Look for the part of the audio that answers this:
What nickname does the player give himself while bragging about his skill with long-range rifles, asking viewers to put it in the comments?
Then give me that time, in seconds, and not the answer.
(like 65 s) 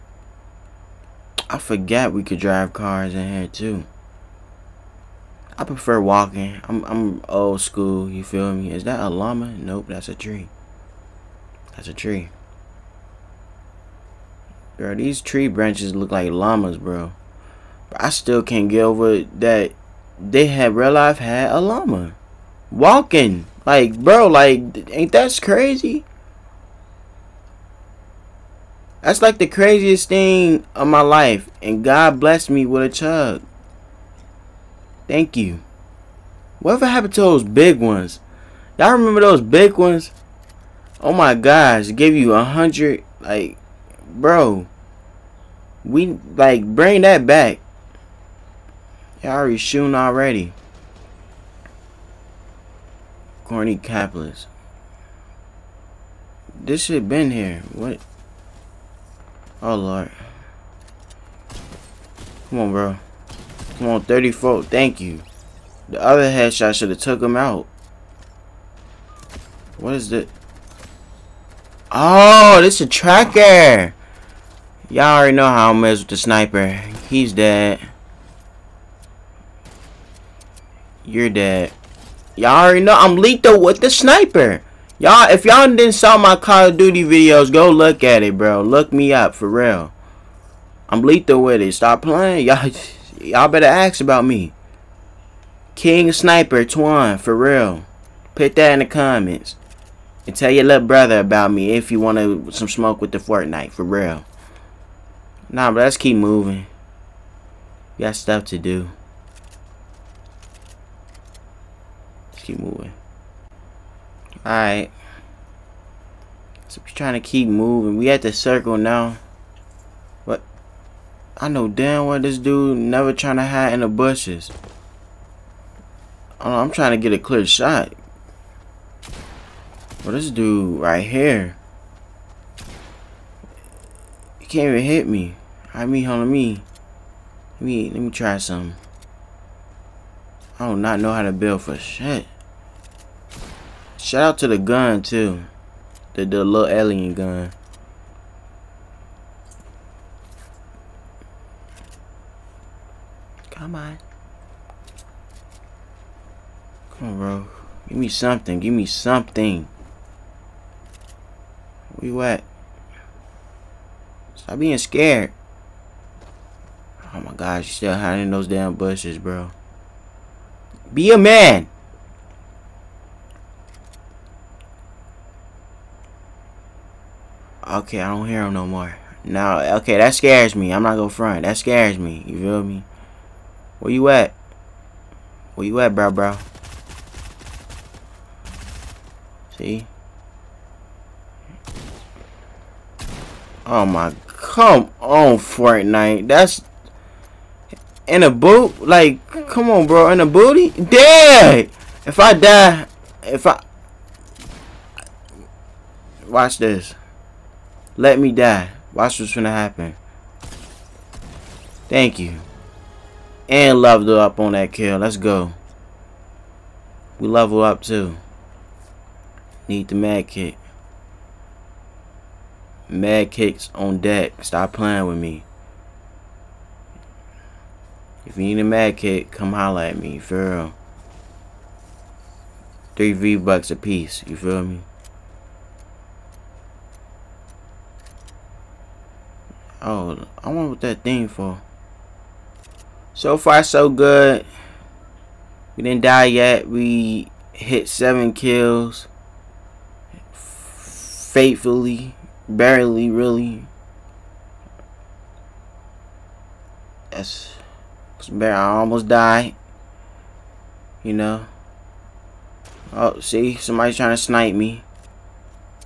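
95 s.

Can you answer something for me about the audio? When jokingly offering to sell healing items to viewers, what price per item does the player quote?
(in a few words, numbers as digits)
3 V bucks.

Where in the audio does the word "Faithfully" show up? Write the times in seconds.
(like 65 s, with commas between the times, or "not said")
250 s.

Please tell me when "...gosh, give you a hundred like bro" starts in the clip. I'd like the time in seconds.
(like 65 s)
41 s.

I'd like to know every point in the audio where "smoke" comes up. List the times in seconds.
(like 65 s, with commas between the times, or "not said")
102 s.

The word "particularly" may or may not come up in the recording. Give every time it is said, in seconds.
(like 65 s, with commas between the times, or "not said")
not said.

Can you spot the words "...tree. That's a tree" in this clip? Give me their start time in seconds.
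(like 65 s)
10 s.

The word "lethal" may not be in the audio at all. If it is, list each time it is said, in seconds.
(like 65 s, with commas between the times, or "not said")
83 s, 91 s.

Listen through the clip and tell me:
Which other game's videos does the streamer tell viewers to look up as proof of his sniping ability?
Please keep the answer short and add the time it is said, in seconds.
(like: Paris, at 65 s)
Call of Duty, at 86 s.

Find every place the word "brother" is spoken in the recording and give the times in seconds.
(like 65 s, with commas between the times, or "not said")
100 s.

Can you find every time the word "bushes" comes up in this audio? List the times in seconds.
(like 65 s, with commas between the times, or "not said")
123 s, 168 s.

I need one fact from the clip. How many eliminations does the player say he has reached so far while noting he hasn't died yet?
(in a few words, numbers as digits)
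7.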